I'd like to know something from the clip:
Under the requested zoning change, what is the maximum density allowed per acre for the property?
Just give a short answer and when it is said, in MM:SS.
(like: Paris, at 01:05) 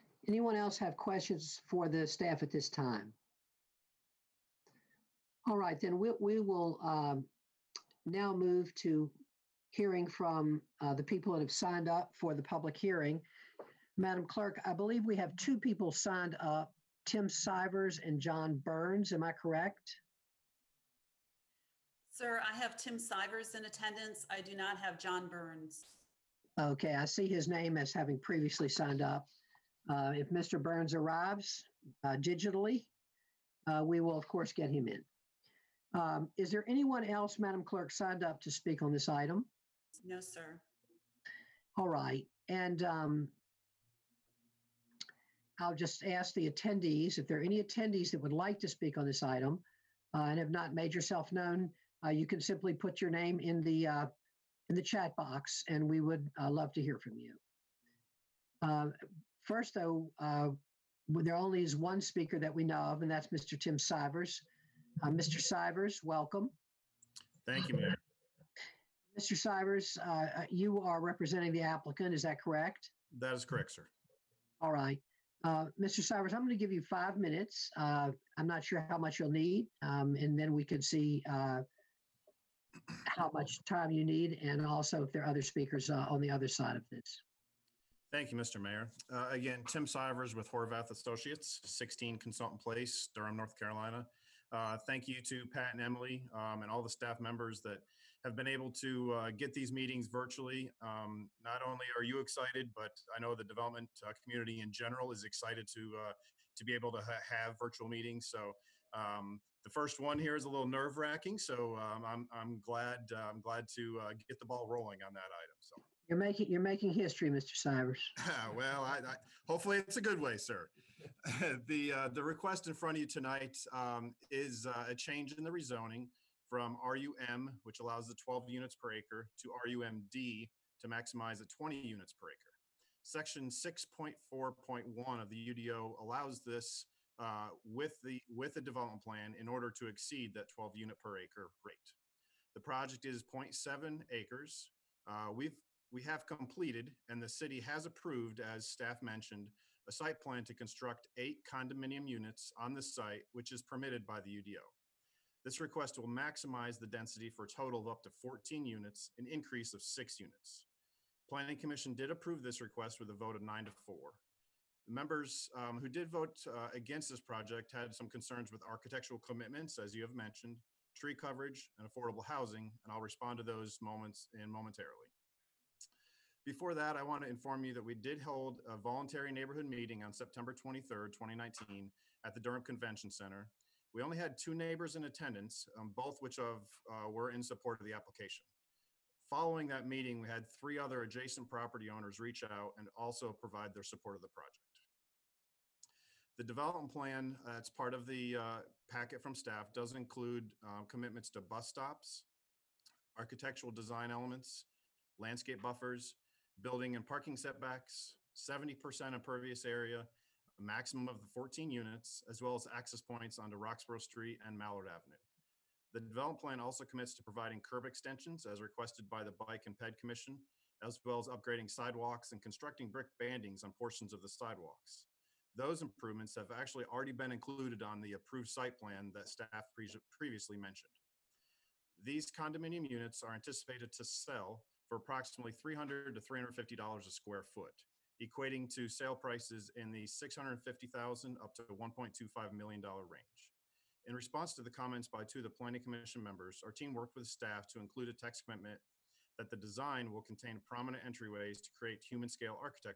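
20 units per acre, at 02:11.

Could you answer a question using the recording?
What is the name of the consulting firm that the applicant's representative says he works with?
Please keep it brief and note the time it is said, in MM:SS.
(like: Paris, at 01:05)
Horvath Associates, at 01:30.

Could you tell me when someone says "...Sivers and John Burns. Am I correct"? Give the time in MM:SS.
00:17.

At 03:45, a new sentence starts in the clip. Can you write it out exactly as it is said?
Those improvements have actually already been included on the approved site plan that staff pre previously mentioned.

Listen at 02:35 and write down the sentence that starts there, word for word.
This request will maximize the density for a total of up to 14 units, an increase of six units.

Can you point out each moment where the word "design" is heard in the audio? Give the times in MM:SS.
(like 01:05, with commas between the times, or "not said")
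03:23, 04:09.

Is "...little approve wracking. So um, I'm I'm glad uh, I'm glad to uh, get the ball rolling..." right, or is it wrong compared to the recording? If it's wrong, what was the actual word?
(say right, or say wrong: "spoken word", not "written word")
wrong: "nerve", not "approve".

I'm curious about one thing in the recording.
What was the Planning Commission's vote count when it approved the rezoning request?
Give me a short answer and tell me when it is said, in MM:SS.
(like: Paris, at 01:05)
9 to 4, at 02:43.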